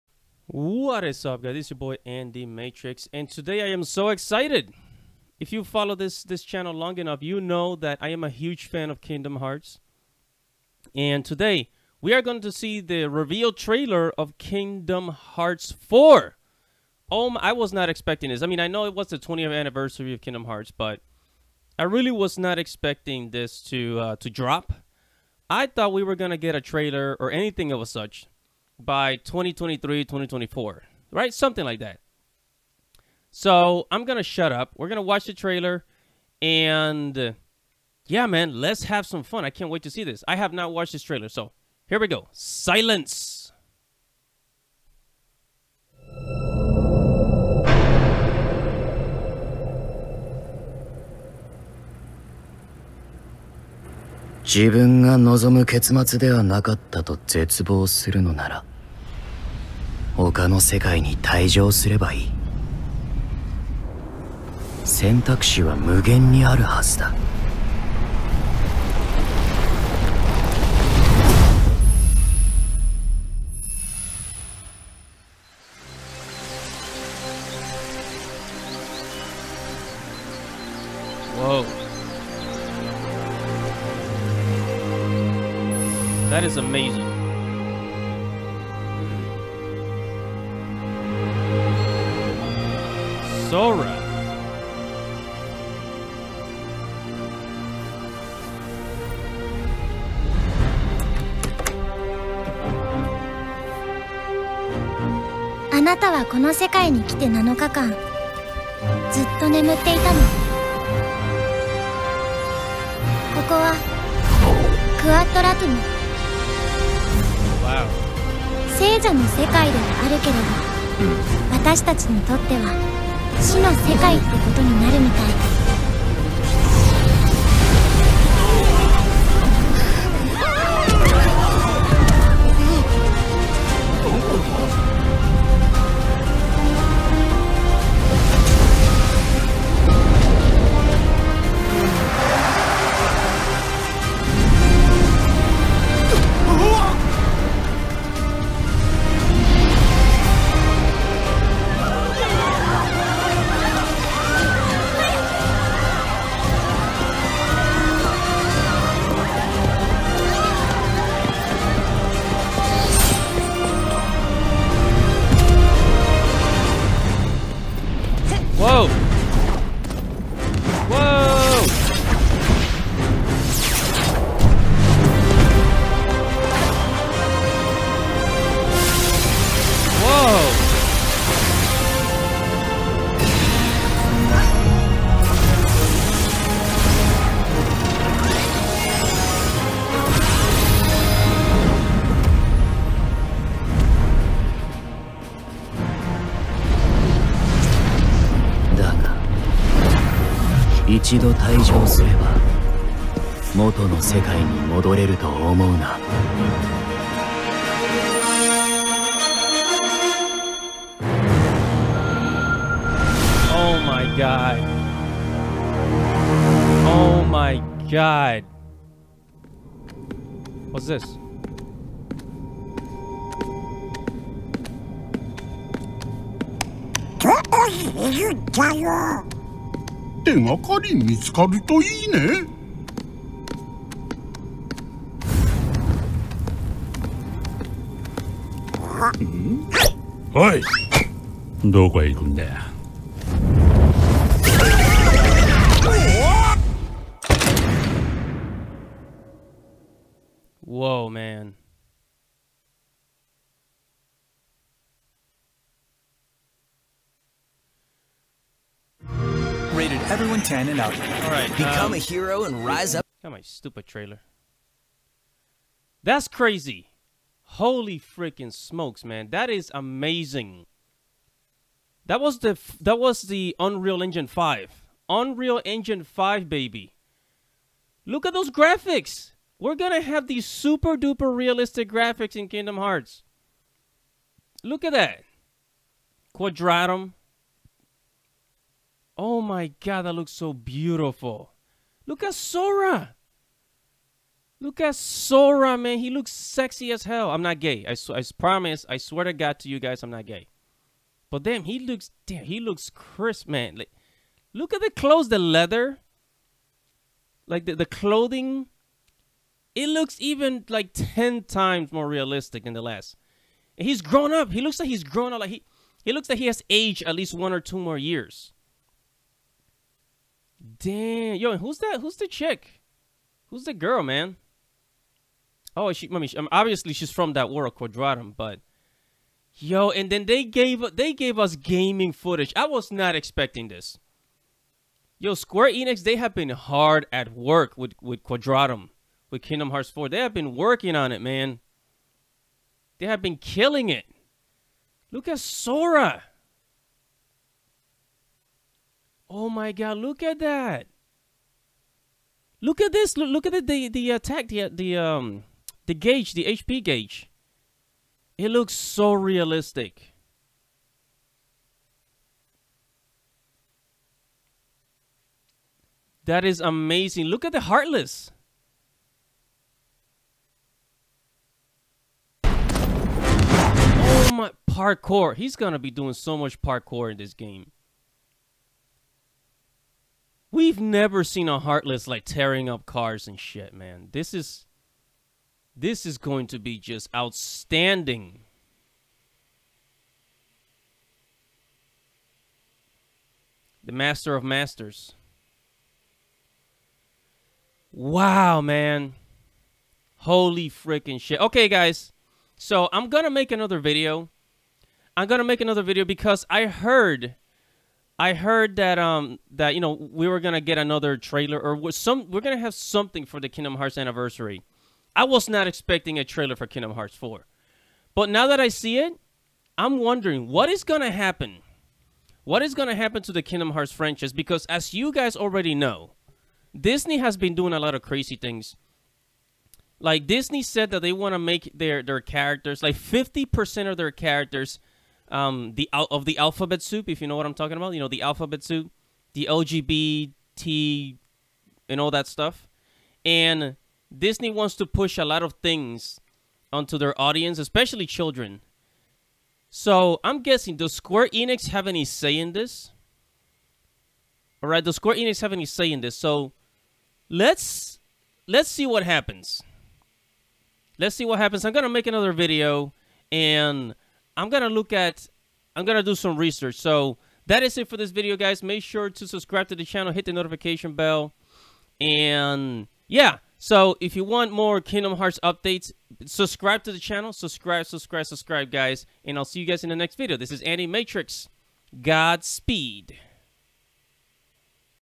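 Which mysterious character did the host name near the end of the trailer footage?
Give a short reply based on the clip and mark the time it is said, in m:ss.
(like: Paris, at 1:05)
The Master of Masters, at 6:33.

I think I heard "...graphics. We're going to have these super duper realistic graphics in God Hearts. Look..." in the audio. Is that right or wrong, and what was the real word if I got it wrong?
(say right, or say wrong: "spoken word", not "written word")
wrong: "Kingdom", not "God".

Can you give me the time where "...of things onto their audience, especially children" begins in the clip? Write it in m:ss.
7:25.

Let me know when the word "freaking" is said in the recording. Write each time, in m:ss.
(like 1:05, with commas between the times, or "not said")
4:27, 6:40.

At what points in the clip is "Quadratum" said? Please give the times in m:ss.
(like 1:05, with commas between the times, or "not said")
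4:46, 5:27, 5:38.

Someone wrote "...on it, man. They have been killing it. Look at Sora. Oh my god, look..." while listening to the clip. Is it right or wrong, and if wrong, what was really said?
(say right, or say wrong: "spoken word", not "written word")
right.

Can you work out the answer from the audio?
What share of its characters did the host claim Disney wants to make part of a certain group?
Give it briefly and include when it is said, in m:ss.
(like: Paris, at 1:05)
50%, at 7:12.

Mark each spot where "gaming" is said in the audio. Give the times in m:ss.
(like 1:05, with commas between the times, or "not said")
5:31.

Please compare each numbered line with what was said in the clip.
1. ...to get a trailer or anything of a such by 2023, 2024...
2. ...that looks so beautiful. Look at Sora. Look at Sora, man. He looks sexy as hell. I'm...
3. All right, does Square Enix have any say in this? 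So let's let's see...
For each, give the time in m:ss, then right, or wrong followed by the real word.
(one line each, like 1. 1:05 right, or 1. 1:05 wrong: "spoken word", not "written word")
1. 0:26 right
2. 4:50 right
3. 7:34 right.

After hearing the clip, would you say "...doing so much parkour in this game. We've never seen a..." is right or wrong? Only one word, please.
right.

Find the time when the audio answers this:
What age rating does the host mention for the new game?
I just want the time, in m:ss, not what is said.
4:20.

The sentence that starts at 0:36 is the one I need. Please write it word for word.
And yeah, man, let's have some fun.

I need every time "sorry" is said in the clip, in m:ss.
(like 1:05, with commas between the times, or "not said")
not said.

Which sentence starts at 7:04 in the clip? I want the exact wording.
Because as you guys already know, Disney has been doing a lot of crazy things.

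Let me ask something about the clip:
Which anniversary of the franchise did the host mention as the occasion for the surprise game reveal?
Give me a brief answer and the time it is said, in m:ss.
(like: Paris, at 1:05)
20th, at 0:19.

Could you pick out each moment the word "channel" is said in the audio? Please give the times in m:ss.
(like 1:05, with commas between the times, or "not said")
0:06, 7:49, 7:56.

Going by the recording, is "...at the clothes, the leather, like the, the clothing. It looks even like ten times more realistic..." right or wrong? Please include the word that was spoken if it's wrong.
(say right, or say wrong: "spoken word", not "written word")
right.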